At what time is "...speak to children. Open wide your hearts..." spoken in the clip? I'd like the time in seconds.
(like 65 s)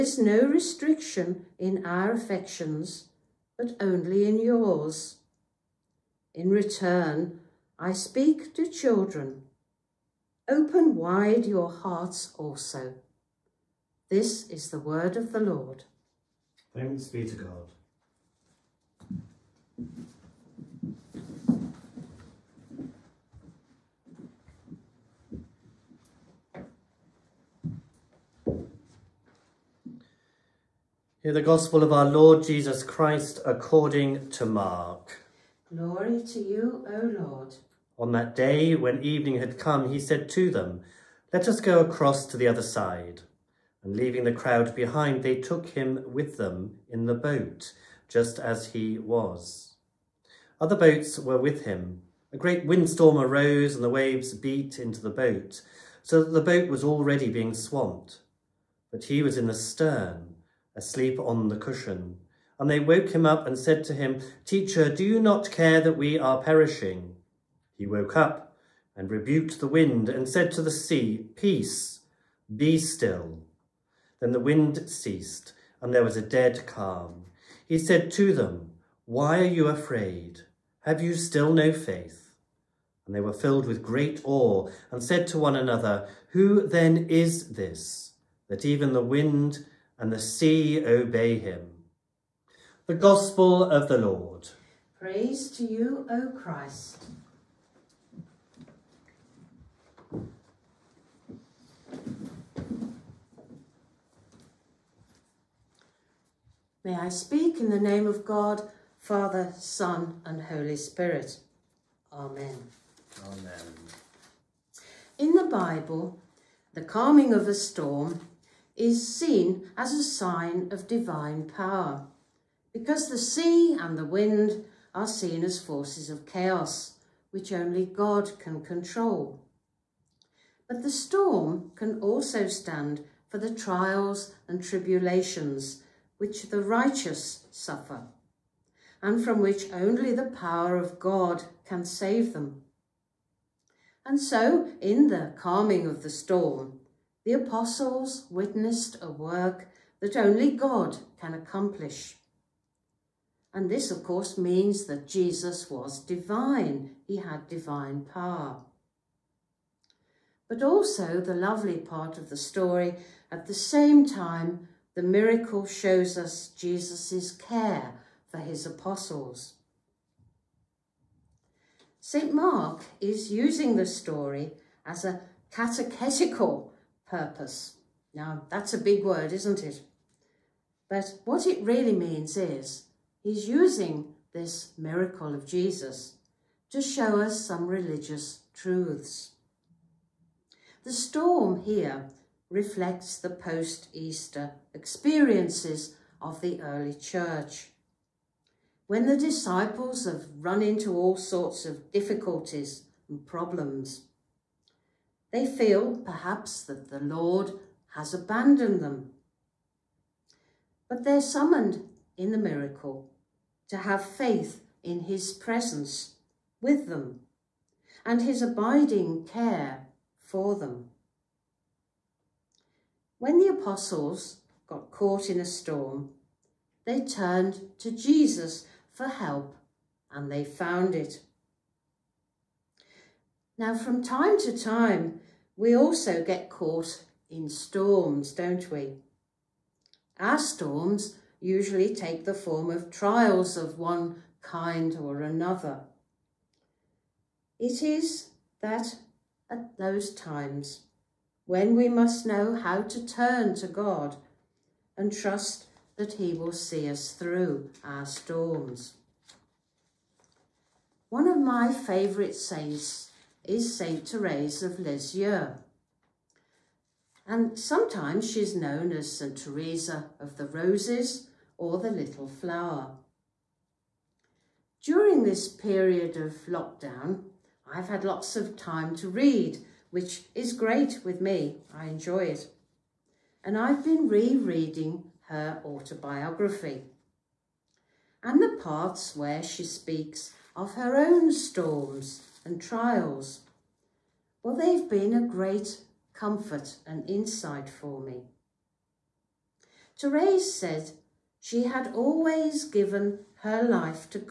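7 s.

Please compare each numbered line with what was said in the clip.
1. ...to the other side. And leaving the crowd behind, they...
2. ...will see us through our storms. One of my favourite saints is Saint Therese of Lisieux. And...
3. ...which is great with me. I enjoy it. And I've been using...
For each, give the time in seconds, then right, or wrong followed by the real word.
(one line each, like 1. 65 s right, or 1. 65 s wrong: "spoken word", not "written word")
1. 42 s right
2. 256 s right
3. 279 s wrong: "rereading", not "using".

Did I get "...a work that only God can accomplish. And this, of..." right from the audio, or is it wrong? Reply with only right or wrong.
right.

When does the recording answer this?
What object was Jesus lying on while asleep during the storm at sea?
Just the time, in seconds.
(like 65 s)
61 s.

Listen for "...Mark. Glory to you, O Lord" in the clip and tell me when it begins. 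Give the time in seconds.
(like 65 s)
34 s.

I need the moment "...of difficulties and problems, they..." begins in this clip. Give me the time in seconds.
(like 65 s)
201 s.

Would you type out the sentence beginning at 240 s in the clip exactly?
Our storms usually take the form of trials of one kind or another.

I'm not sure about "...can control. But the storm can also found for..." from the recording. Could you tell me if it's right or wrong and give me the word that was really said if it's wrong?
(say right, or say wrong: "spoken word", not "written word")
wrong: "stand", not "found".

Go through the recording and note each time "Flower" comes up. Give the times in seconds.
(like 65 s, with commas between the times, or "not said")
272 s.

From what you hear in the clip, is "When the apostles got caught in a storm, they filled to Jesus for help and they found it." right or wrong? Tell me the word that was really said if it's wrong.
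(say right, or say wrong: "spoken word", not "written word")
wrong: "turned", not "filled".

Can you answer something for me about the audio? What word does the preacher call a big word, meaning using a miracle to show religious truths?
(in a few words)
Catechetical.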